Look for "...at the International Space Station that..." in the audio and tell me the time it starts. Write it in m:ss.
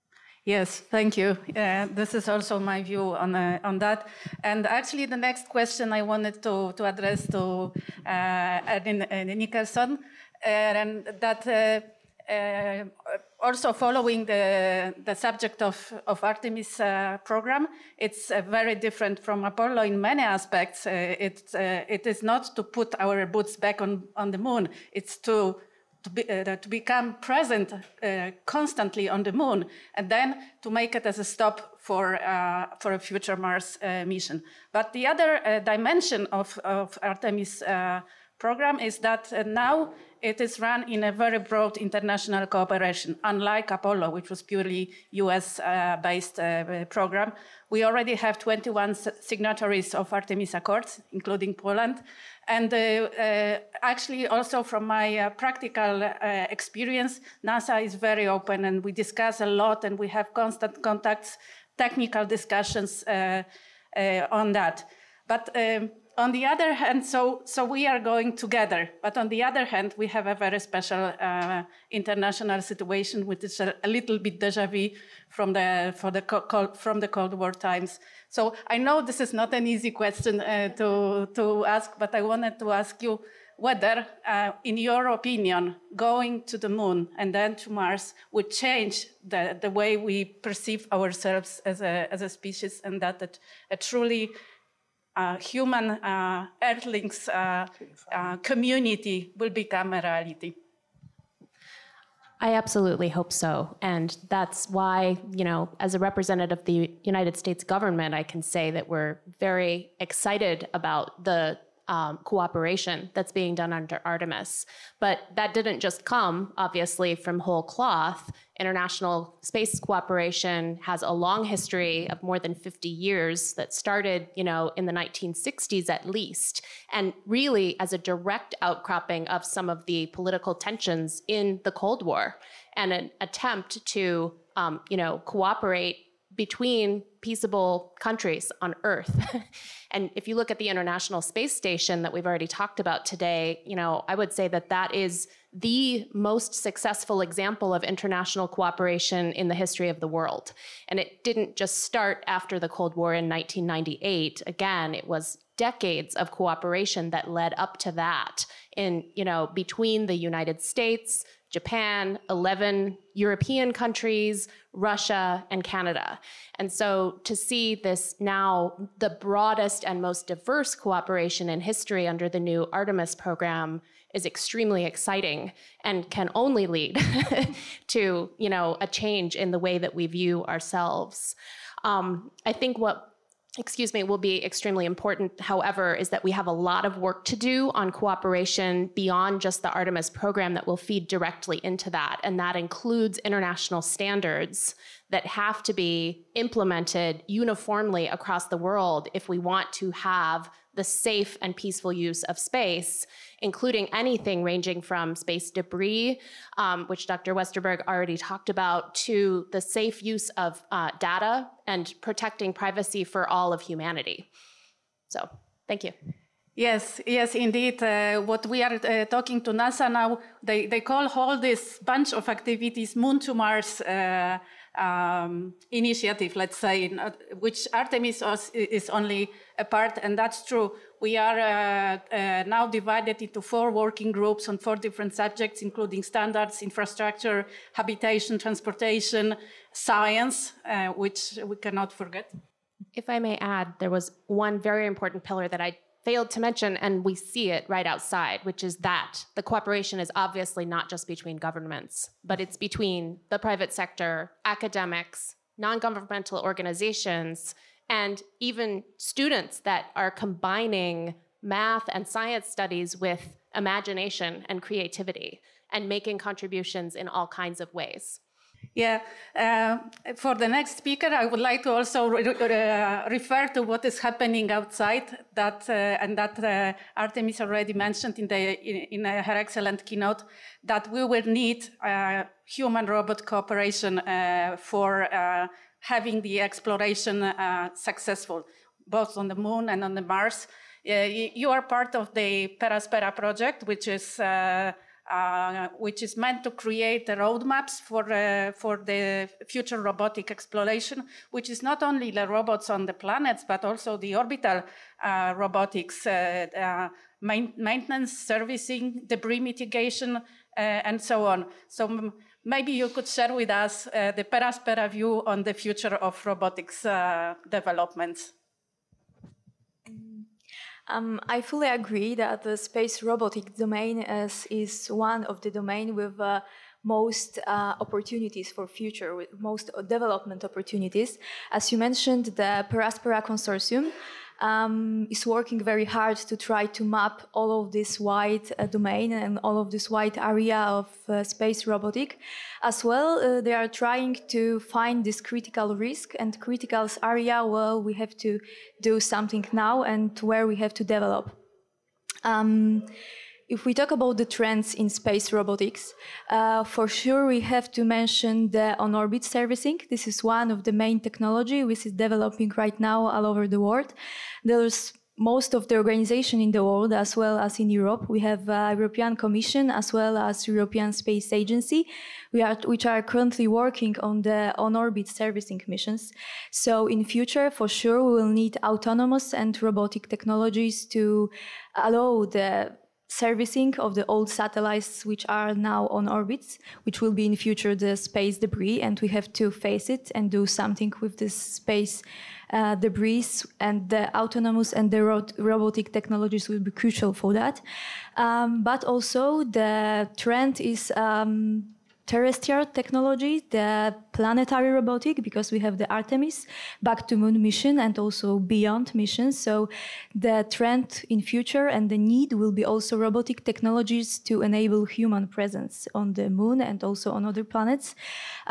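2:20.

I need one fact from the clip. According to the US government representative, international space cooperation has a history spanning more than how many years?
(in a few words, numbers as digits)
50.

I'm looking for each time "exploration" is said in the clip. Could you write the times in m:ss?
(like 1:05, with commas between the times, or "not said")
4:46, 5:00.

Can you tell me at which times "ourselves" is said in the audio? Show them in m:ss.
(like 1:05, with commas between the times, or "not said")
1:30, 3:00.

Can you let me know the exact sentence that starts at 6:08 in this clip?
We have uh, European Commission as well as European Space Agency, are, which are currently working on the on-orbit servicing missions.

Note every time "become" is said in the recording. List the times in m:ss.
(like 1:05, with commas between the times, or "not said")
0:26, 1:39.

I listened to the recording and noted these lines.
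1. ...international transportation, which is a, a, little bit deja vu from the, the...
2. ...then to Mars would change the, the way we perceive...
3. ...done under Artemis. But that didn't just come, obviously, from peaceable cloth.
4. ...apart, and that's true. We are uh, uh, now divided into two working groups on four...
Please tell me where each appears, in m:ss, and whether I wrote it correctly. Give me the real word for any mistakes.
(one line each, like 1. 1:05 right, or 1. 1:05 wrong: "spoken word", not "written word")
1. 1:11 wrong: "situation", not "transportation"
2. 1:27 right
3. 1:53 wrong: "whole", not "peaceable"
4. 3:49 wrong: "four", not "two".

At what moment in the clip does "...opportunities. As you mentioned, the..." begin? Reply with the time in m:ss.
5:30.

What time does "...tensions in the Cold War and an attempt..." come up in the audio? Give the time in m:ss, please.
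2:10.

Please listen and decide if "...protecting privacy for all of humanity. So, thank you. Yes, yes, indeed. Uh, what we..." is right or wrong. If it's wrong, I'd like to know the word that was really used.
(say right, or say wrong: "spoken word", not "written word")
right.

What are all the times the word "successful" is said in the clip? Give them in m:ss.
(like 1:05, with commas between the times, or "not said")
2:26, 4:47.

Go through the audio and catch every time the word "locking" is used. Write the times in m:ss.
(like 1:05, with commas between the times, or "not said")
not said.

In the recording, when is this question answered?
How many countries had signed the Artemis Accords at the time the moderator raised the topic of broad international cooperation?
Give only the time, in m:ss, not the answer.
0:48.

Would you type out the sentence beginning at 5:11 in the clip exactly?
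So maybe you could share with us uh, the Peraspera view on the future of robotics uh, developments.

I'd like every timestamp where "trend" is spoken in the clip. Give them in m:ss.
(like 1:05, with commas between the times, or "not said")
5:54, 6:40, 6:50.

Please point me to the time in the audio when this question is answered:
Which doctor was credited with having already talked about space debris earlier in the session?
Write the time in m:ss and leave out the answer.
3:27.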